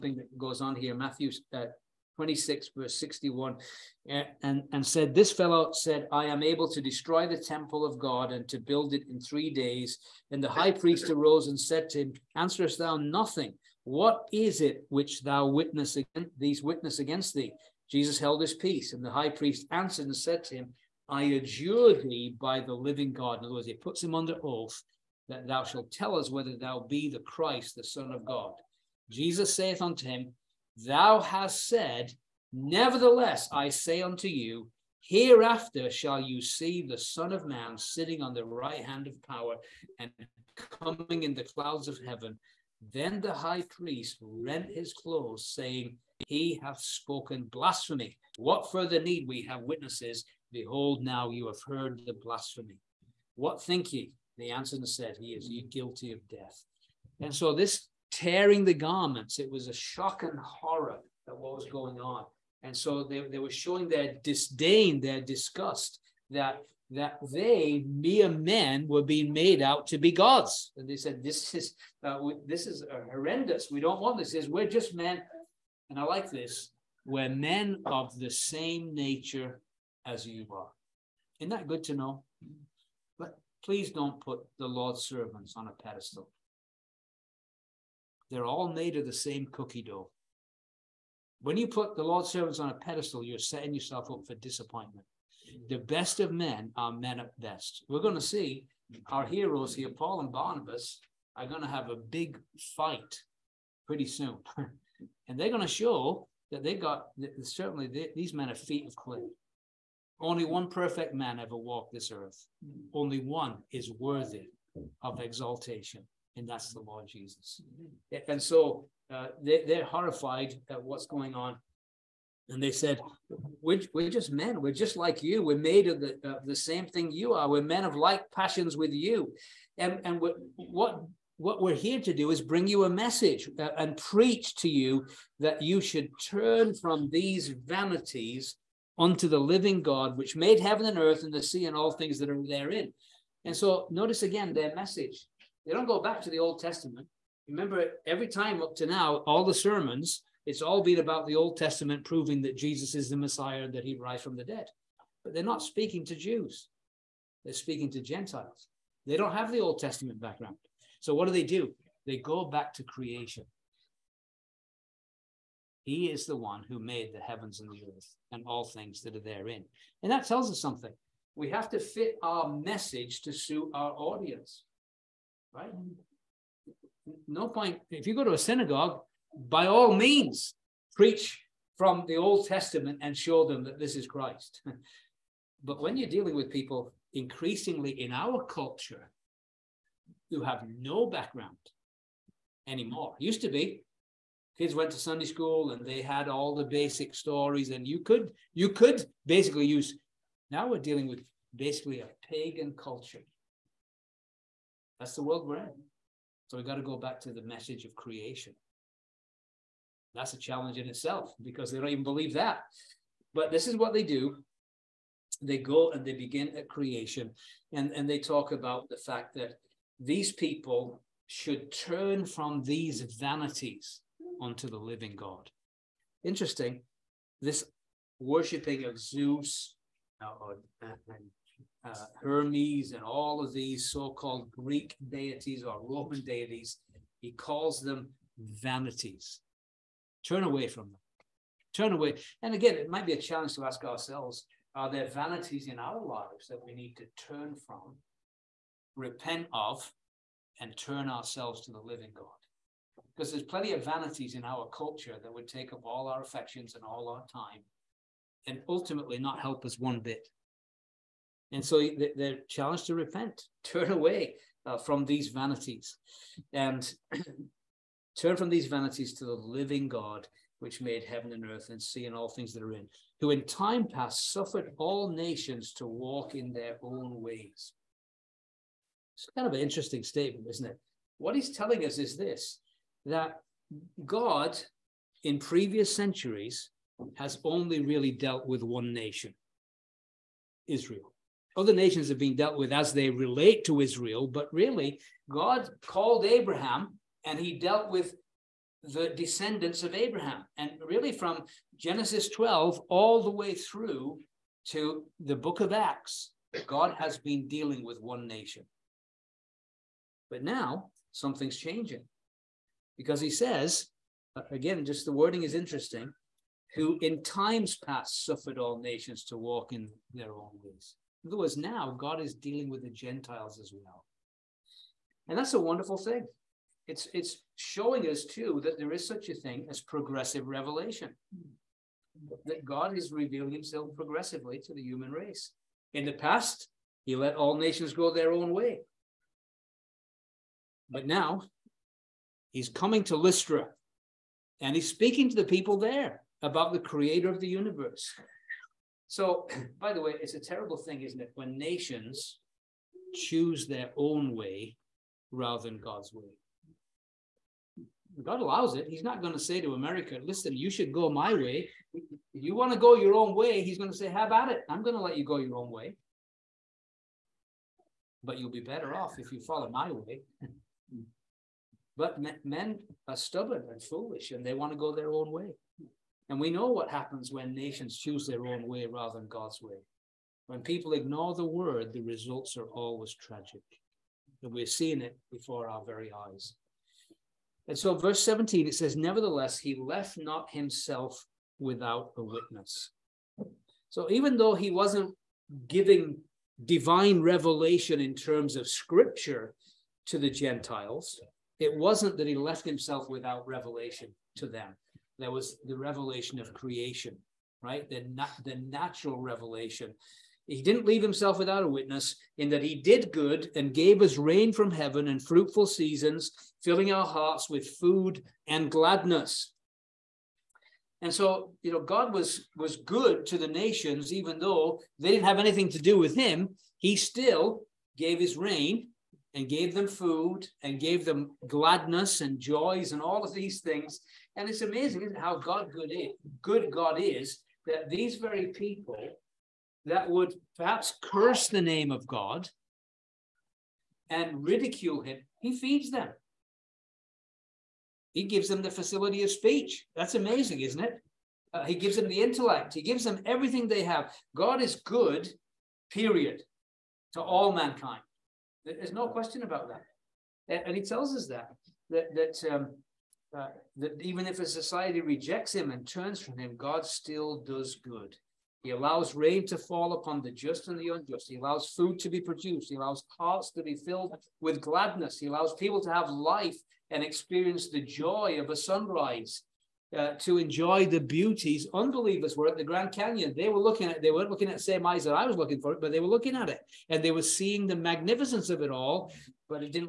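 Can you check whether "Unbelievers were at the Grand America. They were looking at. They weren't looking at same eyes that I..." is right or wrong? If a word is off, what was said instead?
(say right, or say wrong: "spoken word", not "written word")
wrong: "Canyon", not "America".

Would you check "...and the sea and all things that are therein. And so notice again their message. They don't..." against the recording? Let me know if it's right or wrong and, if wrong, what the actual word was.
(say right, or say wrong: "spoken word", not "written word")
right.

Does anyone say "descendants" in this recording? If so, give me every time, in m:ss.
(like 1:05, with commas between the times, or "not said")
4:59.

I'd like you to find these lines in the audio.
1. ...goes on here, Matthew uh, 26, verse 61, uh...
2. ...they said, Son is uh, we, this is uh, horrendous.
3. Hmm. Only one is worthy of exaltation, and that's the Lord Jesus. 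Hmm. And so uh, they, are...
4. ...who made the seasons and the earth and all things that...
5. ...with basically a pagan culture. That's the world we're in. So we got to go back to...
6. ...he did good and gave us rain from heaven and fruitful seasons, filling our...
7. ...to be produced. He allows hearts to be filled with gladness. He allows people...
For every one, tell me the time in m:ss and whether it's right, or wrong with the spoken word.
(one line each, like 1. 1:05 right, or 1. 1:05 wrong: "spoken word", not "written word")
1. 0:00 right
2. 1:10 wrong: "This", not "Son"
3. 1:52 right
4. 2:46 wrong: "heavens", not "seasons"
5. 3:21 right
6. 6:52 right
7. 7:51 right.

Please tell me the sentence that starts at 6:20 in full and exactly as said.
When people ignore the word, the results are always tragic.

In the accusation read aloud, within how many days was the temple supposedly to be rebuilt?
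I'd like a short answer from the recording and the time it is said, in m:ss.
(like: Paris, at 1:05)
3 days, at 0:09.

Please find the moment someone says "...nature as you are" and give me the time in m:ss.
1:18.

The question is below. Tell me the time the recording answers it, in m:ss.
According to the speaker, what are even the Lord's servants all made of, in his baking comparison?
1:29.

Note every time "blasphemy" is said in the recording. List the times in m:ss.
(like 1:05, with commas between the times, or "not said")
0:47, 0:52.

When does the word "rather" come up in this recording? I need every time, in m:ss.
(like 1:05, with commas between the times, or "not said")
5:55, 6:18.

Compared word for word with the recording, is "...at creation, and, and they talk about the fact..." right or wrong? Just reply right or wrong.
right.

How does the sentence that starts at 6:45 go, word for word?
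There was the revelation of creation, right?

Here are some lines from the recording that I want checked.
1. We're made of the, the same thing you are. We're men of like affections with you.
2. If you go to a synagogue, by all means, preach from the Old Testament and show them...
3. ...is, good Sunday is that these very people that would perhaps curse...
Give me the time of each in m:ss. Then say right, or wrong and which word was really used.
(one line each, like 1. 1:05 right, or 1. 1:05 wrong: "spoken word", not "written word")
1. 2:05 wrong: "passions", not "affections"
2. 2:57 right
3. 7:15 wrong: "God", not "Sunday".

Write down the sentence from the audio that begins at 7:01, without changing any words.
And so, you know, God was was good to the nations, even though they didn't have anything to do with him.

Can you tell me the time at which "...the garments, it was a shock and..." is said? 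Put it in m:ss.
0:58.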